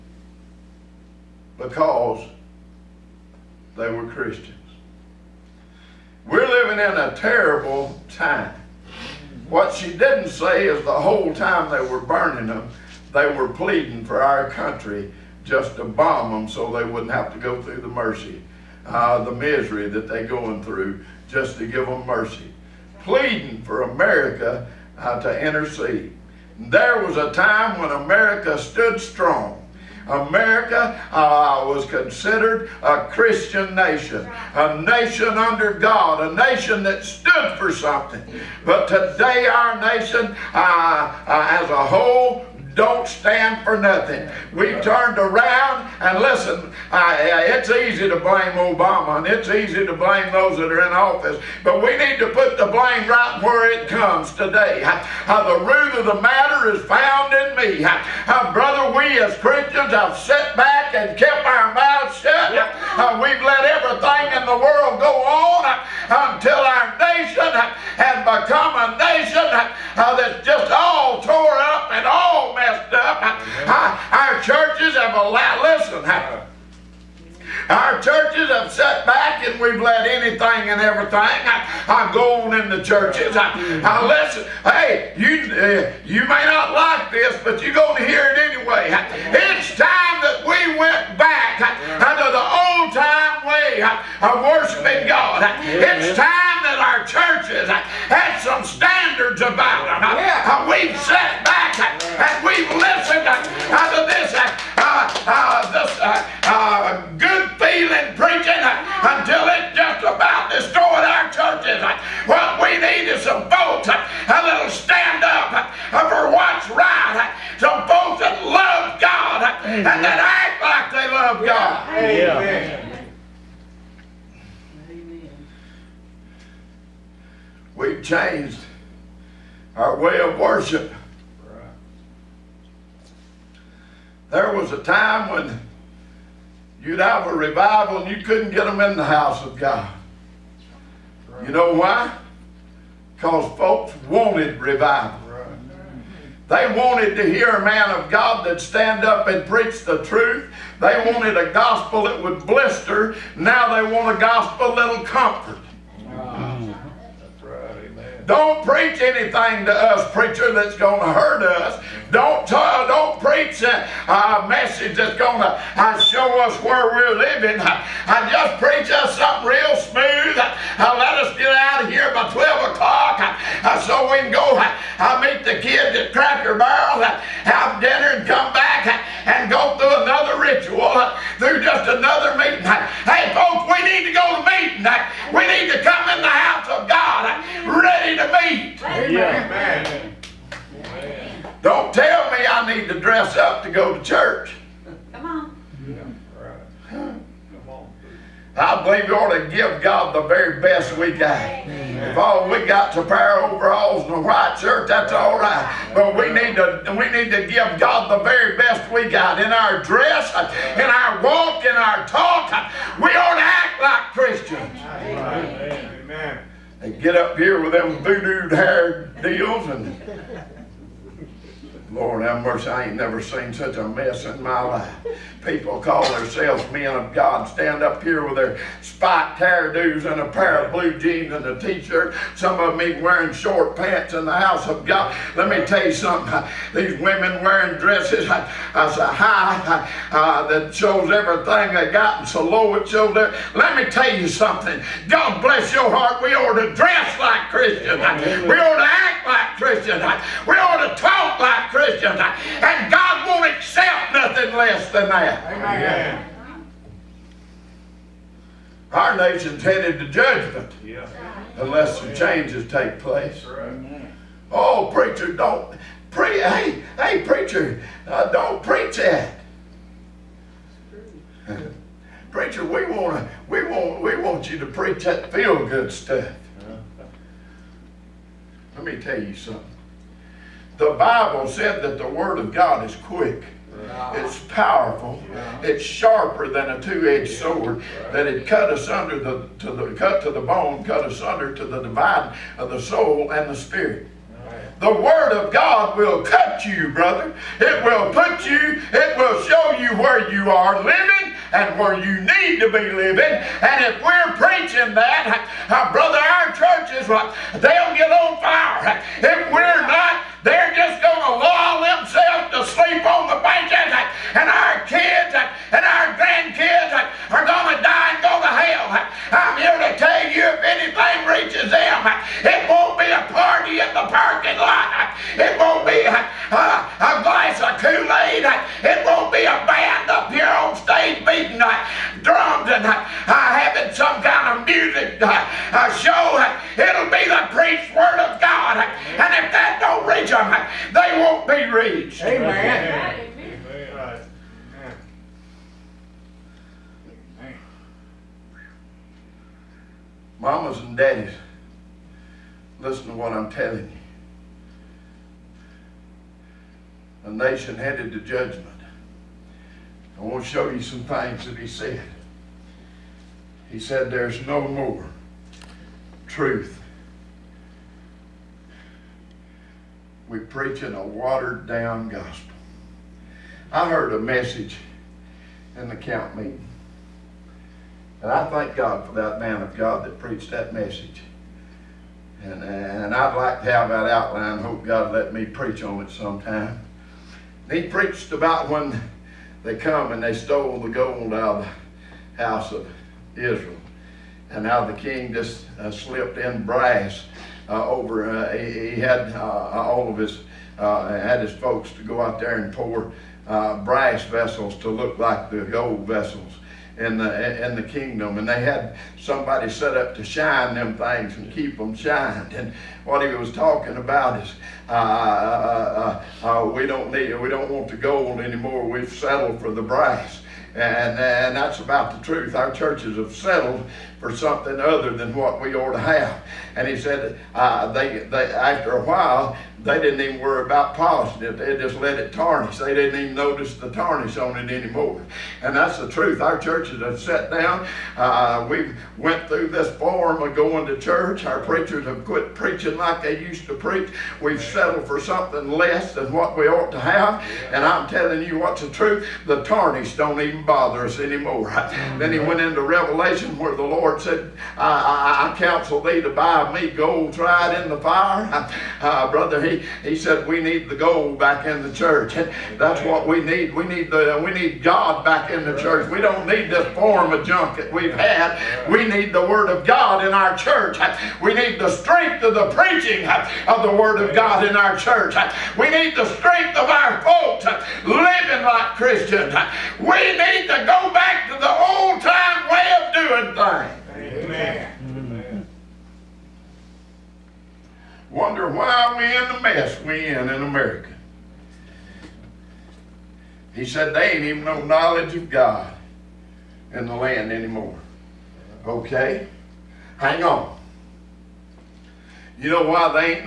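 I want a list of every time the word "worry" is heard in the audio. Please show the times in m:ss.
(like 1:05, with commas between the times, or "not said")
7:10.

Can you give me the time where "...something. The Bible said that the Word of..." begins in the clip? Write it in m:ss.
4:39.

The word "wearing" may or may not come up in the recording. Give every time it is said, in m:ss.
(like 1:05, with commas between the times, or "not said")
3:53, 3:57.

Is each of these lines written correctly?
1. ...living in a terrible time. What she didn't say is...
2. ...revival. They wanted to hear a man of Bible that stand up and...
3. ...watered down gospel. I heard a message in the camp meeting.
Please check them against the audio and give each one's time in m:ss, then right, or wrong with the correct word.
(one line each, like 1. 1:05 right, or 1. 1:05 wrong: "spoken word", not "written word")
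1. 0:06 right
2. 2:24 wrong: "God", not "Bible"
3. 6:11 right.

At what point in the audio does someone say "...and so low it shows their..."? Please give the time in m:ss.
4:02.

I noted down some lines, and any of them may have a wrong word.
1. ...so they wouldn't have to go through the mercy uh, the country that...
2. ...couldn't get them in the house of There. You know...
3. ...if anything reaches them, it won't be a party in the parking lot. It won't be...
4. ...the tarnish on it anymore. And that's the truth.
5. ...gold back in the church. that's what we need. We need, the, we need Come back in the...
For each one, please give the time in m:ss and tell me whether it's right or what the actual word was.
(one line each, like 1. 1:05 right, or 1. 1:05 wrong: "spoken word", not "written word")
1. 0:16 wrong: "misery", not "country"
2. 2:18 wrong: "God", not "There"
3. 5:20 right
4. 7:13 right
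5. 7:40 wrong: "God", not "Come".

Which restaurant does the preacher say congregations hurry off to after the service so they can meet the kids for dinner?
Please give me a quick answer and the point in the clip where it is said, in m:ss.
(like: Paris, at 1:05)
Cracker Barrel, at 2:56.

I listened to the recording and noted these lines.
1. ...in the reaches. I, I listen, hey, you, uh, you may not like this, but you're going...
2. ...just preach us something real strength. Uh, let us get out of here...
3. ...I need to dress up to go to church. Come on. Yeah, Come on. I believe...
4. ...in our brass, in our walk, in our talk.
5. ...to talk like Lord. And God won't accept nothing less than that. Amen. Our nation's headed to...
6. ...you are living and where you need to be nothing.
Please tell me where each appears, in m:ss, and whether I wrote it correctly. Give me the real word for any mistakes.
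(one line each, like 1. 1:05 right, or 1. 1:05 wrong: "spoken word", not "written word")
1. 1:22 wrong: "churches", not "reaches"
2. 2:48 wrong: "smooth", not "strength"
3. 3:12 right
4. 3:29 wrong: "dress", not "brass"
5. 4:10 wrong: "Christians", not "Lord"
6. 5:00 wrong: "living", not "nothing".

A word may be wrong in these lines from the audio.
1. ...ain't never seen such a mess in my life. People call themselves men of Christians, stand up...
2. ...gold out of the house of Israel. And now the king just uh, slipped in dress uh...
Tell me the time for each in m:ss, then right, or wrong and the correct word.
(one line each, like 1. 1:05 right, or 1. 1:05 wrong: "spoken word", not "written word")
1. 3:42 wrong: "God", not "Christians"
2. 6:30 wrong: "brass", not "dress".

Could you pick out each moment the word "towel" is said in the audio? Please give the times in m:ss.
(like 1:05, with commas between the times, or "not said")
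not said.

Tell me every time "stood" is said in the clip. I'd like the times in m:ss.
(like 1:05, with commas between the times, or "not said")
0:28, 0:37.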